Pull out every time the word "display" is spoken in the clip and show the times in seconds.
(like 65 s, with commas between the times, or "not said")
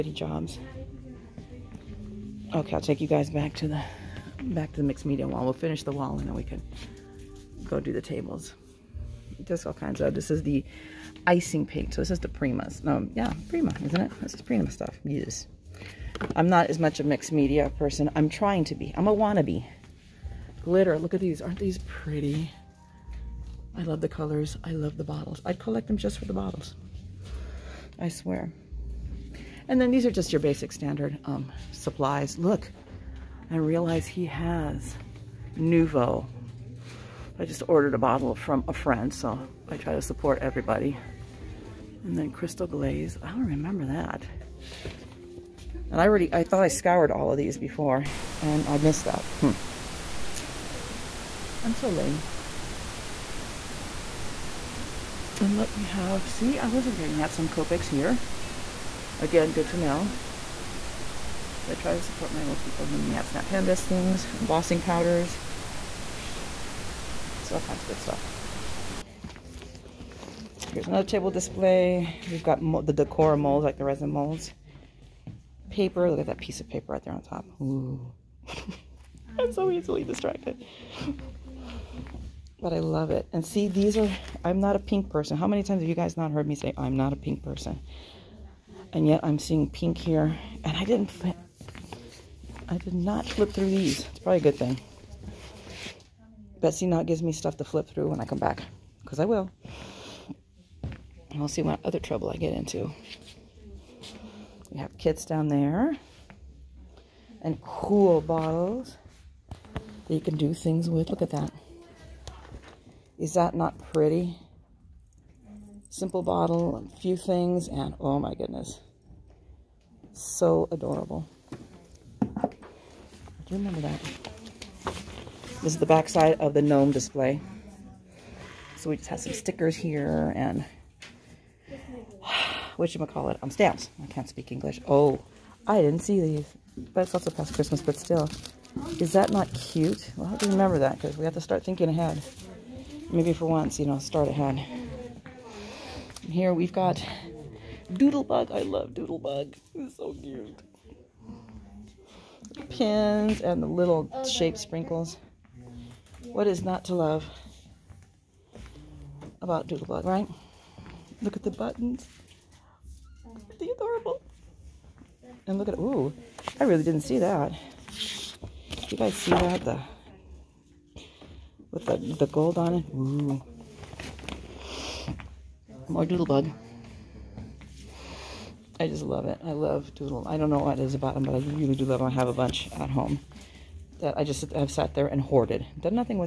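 71 s, 126 s.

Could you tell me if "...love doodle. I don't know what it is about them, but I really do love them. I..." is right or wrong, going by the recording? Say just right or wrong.
right.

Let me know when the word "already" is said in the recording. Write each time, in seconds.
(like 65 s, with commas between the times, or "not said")
46 s.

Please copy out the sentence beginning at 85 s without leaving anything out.
How many times have you guys not heard me say, I'm not a pink person?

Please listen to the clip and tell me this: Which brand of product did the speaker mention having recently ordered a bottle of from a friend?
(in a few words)
Nuvo.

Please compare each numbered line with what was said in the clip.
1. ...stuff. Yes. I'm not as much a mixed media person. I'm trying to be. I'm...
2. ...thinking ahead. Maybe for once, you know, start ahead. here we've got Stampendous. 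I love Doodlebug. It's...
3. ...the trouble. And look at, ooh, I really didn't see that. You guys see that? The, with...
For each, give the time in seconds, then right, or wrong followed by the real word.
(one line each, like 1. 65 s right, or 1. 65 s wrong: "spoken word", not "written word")
1. 14 s right
2. 141 s wrong: "Doodlebug", not "Stampendous"
3. 163 s wrong: "adorable", not "trouble".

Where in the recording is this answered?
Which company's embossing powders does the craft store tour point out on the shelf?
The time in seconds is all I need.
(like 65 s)
63 s.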